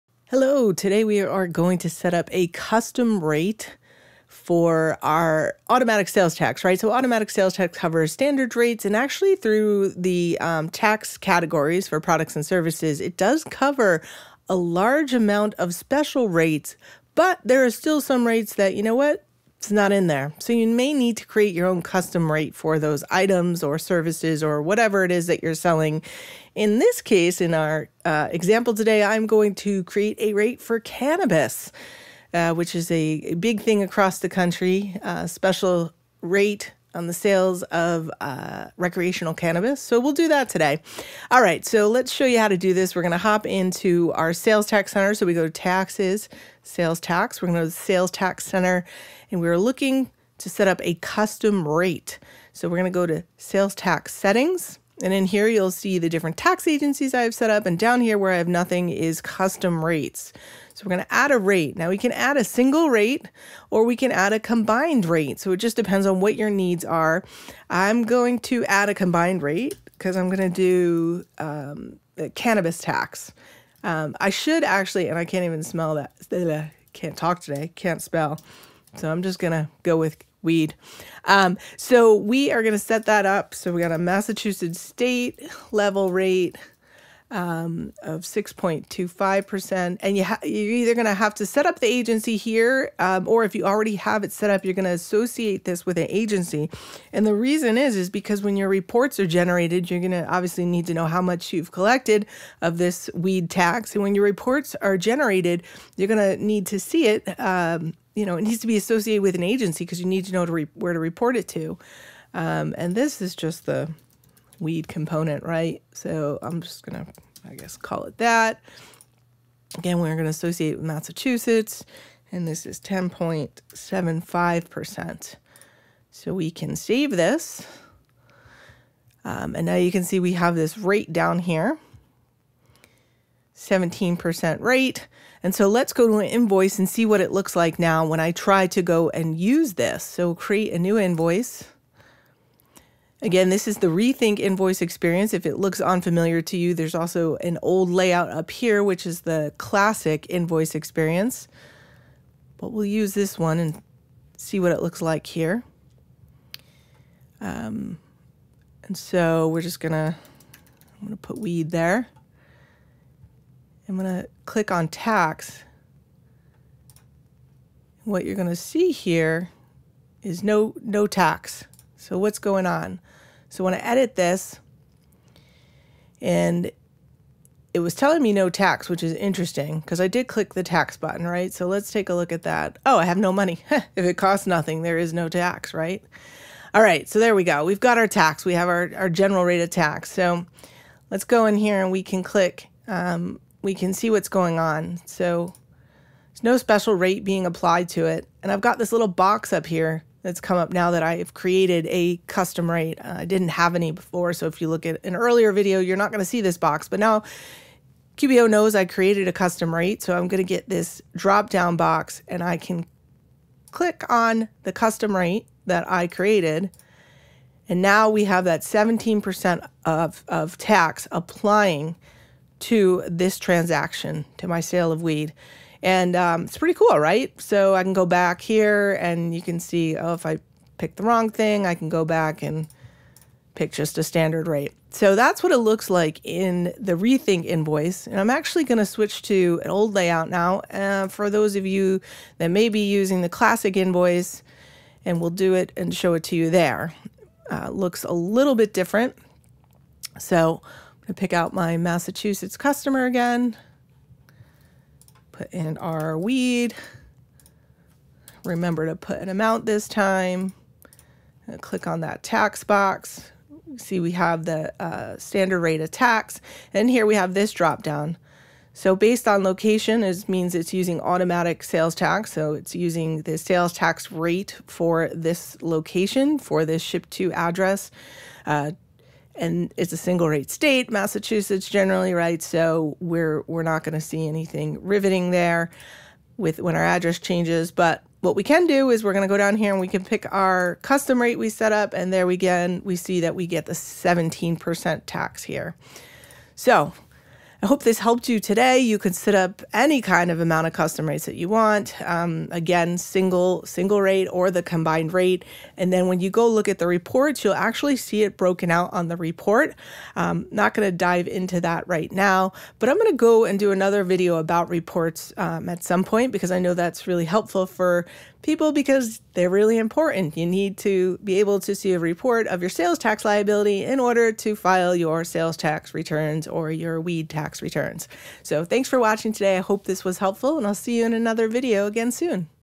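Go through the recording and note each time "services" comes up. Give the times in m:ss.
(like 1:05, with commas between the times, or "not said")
0:12, 0:23.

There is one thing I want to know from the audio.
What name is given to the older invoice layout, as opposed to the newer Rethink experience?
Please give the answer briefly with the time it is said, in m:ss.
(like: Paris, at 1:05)
Classic invoice experience, at 2:29.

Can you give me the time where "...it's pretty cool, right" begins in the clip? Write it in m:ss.
3:46.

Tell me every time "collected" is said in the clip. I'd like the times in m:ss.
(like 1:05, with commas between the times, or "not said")
1:41.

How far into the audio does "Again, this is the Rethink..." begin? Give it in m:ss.
2:23.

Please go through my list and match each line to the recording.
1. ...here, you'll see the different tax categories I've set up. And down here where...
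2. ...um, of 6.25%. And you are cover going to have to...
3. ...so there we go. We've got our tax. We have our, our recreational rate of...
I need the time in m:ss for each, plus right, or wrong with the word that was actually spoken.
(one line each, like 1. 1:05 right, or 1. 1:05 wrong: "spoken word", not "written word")
1. 0:55 wrong: "agencies", not "categories"
2. 1:27 wrong: "either", not "cover"
3. 3:07 wrong: "general", not "recreational".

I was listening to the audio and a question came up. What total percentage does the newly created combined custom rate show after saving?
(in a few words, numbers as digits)
17%.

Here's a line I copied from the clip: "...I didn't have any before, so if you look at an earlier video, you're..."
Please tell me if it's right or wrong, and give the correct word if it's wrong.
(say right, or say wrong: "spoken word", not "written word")
right.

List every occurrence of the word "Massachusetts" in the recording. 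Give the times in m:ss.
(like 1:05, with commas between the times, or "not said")
1:23, 2:00, 4:11, 4:40.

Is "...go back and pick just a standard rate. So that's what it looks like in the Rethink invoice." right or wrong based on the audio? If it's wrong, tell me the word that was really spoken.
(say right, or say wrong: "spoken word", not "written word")
right.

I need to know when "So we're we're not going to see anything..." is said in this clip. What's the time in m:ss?
4:42.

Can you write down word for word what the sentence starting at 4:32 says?
So it's using the sales tax rate for this location, for this ship to address.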